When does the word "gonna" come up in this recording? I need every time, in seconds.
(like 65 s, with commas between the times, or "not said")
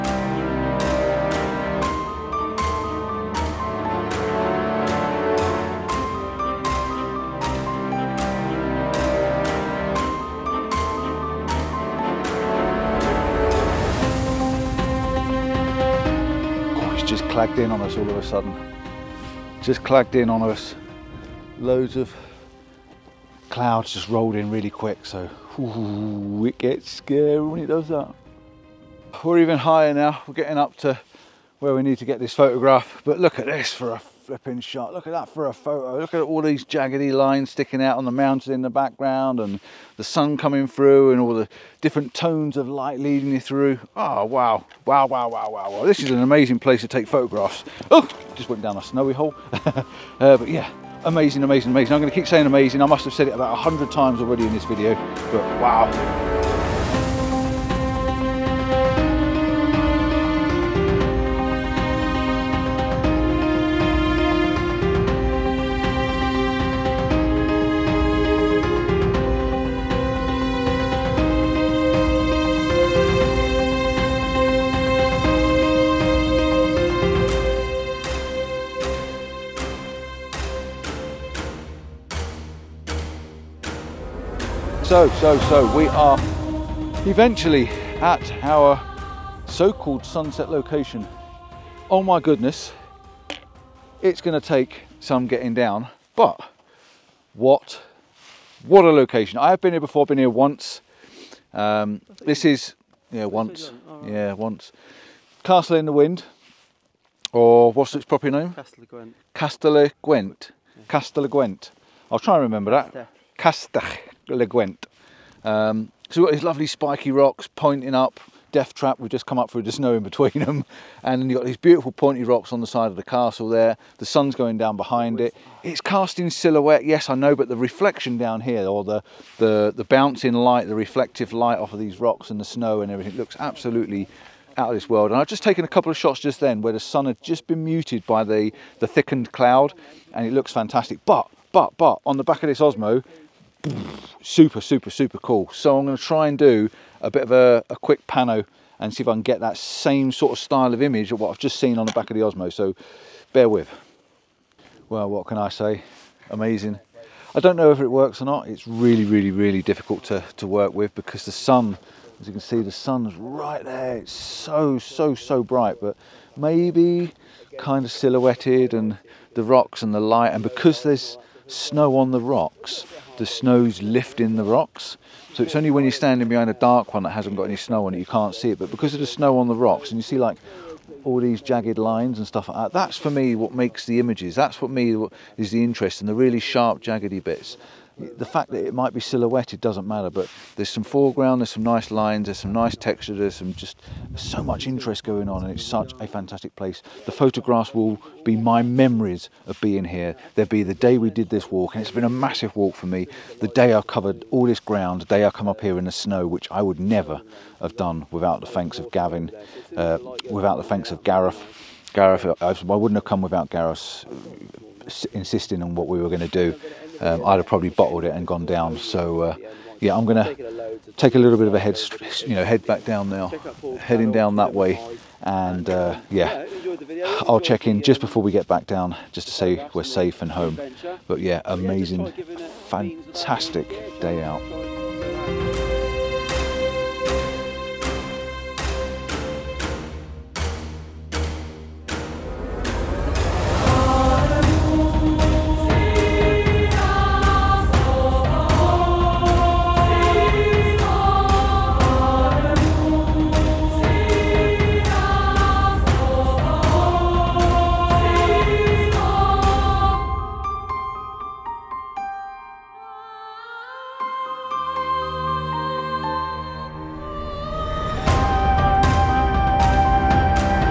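94 s, 145 s, 220 s.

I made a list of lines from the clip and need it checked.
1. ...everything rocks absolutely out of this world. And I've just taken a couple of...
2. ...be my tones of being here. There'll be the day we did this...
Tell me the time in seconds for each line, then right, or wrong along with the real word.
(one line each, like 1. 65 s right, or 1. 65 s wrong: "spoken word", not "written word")
1. 132 s wrong: "looks", not "rocks"
2. 198 s wrong: "memories", not "tones".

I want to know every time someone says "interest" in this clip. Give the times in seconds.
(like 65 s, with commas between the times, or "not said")
185 s, 194 s.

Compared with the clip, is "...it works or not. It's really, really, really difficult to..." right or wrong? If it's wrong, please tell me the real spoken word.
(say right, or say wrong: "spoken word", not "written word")
right.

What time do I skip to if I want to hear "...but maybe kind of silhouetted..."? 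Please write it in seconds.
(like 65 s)
165 s.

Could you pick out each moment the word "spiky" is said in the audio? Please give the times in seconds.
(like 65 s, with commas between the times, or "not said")
116 s.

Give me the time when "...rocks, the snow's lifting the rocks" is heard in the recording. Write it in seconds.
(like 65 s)
172 s.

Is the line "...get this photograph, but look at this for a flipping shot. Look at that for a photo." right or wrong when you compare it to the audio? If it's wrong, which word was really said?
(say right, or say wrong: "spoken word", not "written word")
right.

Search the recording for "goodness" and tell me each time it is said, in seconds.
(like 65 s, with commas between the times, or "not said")
92 s.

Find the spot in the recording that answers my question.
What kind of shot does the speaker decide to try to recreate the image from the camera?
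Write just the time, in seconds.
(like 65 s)
147 s.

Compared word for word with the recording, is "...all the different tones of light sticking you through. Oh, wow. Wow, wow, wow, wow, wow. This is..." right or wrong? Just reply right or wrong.
wrong.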